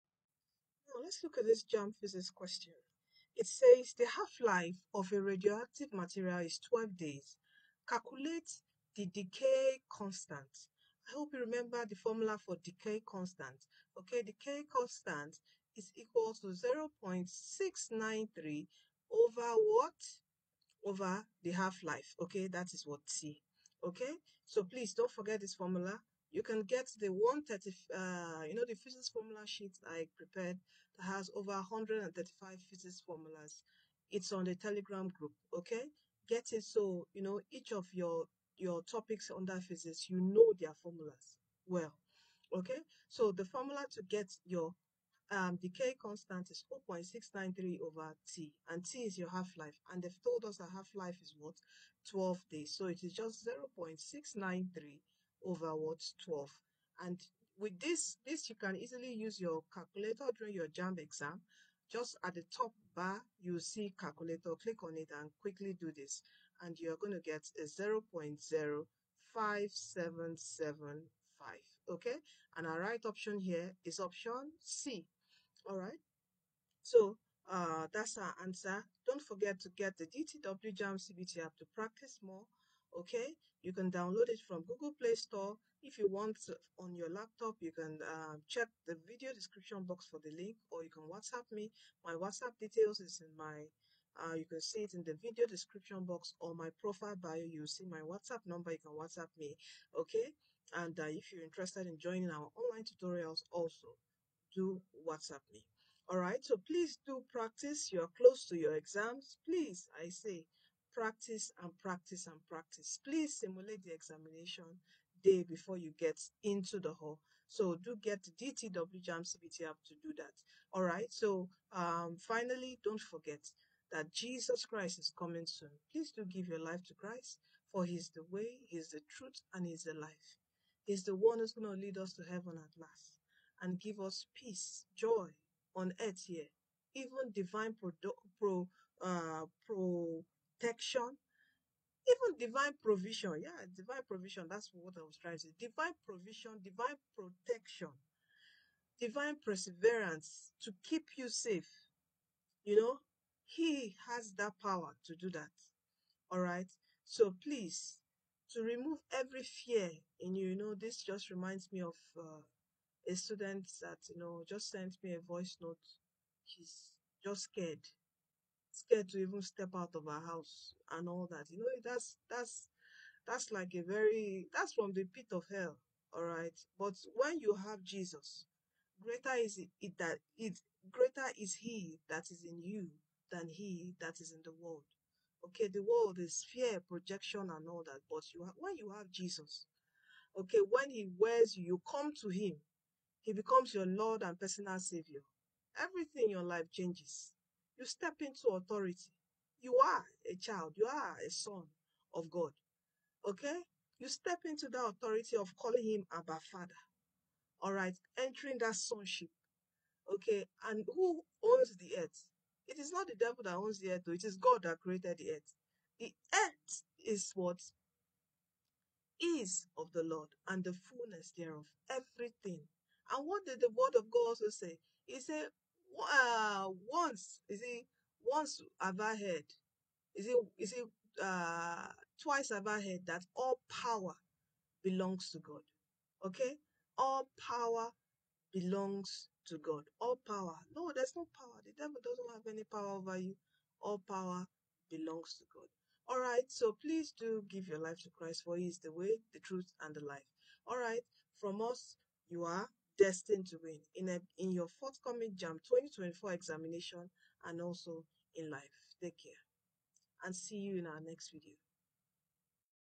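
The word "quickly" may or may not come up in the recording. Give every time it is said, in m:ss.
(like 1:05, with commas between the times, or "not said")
1:05.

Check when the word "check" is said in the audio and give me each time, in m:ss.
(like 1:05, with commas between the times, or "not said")
1:28.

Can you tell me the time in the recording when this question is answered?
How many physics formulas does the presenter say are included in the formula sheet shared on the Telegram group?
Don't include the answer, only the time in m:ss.
0:31.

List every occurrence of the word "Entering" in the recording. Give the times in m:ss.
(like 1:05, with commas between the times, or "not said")
3:28.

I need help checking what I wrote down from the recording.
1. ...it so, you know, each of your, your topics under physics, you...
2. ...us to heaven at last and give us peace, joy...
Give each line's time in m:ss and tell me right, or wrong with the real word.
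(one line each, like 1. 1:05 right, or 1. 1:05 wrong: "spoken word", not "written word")
1. 0:36 right
2. 2:11 right.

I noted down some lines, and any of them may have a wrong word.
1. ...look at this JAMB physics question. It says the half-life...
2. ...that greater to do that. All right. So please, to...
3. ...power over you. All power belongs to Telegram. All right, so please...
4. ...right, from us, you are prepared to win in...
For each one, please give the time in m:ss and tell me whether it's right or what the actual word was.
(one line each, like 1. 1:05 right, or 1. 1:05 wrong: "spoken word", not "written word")
1. 0:01 right
2. 2:34 wrong: "power", not "greater"
3. 4:02 wrong: "God", not "Telegram"
4. 4:10 wrong: "destined", not "prepared".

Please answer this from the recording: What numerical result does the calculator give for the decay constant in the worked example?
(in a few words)
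0.05775.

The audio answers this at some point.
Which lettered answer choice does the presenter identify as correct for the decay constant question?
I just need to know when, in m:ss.
1:13.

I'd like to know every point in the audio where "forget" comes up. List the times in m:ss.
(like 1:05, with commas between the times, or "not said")
0:25, 1:19, 2:03.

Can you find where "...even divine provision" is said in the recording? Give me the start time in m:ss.
2:22.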